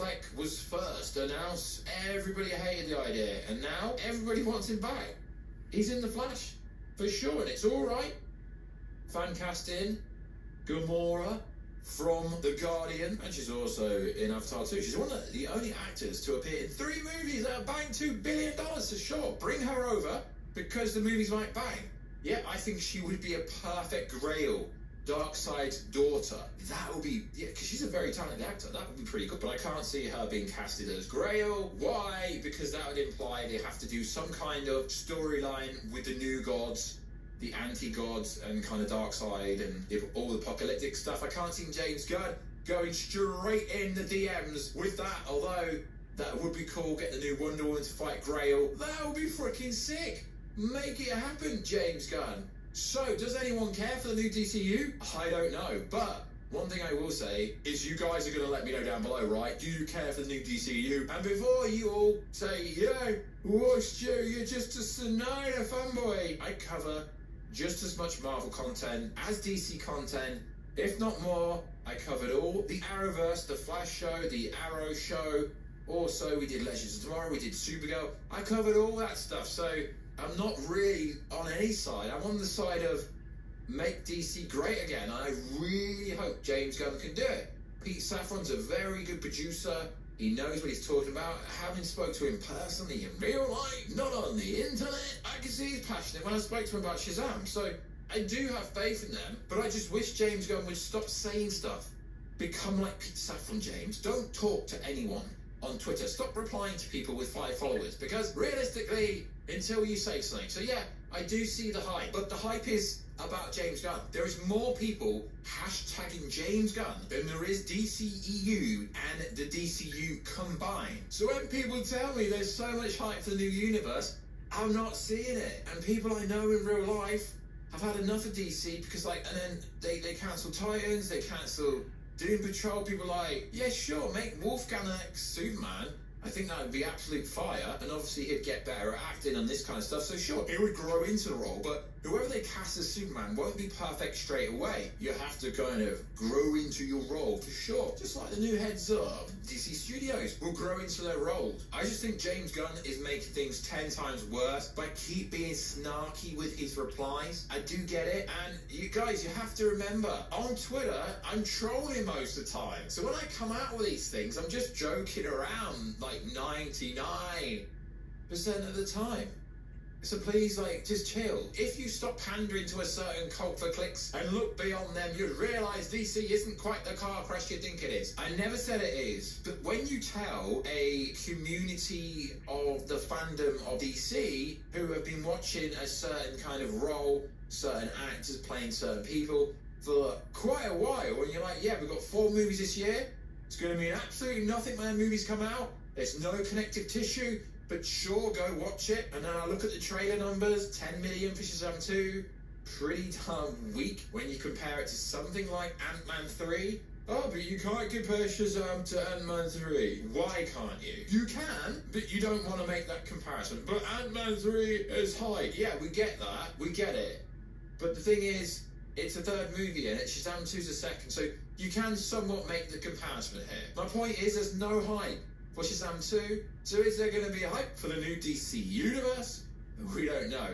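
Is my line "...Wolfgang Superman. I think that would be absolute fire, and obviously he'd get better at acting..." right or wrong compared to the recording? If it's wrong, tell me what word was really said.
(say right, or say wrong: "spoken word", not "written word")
right.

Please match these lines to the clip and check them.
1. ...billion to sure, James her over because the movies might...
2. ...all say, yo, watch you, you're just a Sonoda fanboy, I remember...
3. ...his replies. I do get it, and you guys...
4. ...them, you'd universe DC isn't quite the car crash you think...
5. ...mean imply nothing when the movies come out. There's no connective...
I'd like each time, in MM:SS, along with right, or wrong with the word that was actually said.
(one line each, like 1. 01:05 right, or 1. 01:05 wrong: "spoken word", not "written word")
1. 00:18 wrong: "Bring", not "James"
2. 01:01 wrong: "cover", not "remember"
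3. 02:36 right
4. 02:54 wrong: "realise", not "universe"
5. 03:13 wrong: "absolutely", not "imply".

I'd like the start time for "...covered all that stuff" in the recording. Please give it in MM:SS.
01:18.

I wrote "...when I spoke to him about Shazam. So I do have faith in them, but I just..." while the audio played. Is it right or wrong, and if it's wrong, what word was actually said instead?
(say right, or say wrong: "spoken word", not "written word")
right.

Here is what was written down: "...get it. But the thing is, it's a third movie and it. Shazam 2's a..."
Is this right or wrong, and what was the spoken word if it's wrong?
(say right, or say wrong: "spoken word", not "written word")
right.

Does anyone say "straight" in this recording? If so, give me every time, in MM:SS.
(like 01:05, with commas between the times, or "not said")
00:42, 02:24.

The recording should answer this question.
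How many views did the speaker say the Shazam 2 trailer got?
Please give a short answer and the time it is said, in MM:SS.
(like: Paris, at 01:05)
10 million, at 03:20.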